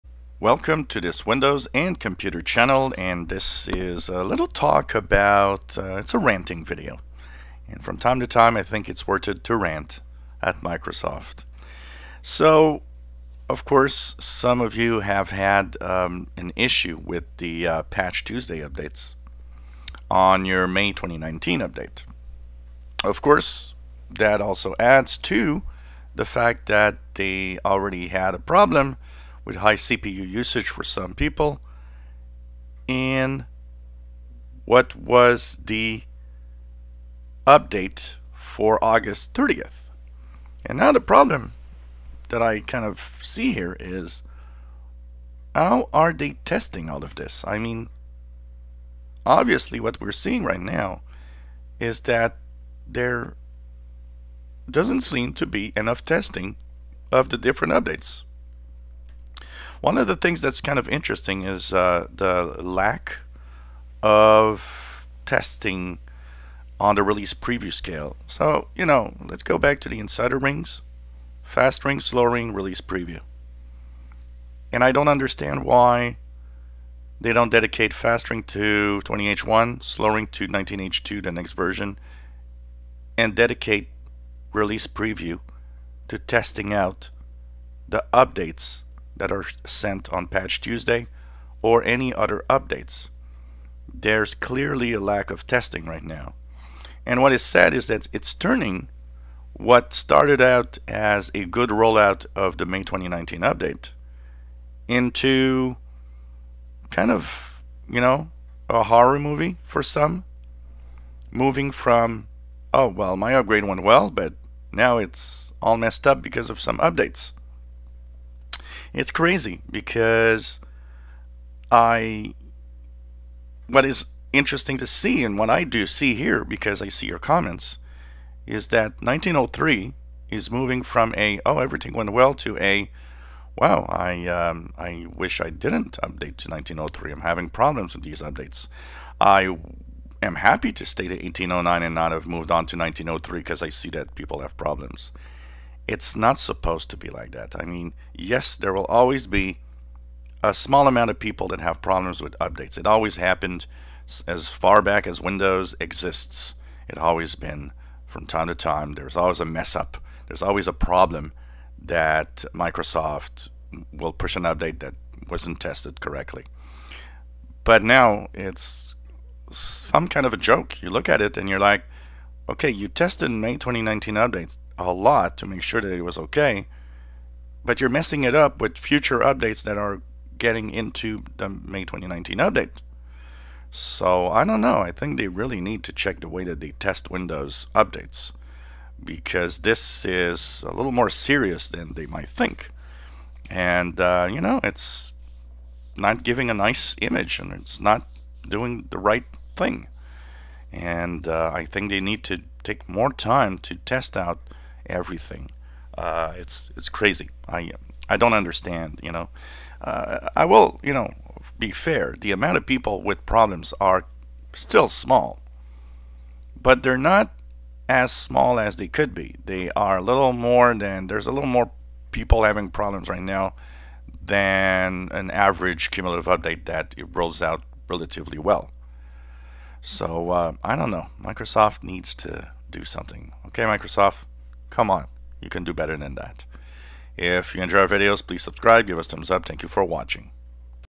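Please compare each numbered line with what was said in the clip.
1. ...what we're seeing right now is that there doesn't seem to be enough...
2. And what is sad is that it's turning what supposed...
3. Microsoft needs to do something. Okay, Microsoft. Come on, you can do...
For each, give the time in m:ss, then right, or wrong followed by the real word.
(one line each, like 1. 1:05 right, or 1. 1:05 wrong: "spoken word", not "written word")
1. 0:49 right
2. 1:37 wrong: "started", not "supposed"
3. 3:51 right.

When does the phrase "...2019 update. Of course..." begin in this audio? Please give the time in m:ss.
0:20.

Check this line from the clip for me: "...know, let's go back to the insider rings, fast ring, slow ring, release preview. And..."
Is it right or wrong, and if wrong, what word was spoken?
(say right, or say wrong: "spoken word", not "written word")
right.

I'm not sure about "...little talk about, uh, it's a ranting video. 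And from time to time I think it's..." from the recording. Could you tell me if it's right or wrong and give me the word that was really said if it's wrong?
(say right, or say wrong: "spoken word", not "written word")
right.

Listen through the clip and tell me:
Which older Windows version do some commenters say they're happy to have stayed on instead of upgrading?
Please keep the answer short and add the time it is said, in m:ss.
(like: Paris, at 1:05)
1809, at 2:21.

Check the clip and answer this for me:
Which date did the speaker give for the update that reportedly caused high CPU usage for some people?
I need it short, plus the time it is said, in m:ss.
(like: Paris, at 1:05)
August 30th, at 0:38.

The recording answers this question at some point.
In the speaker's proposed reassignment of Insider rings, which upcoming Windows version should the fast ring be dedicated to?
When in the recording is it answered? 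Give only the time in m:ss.
1:19.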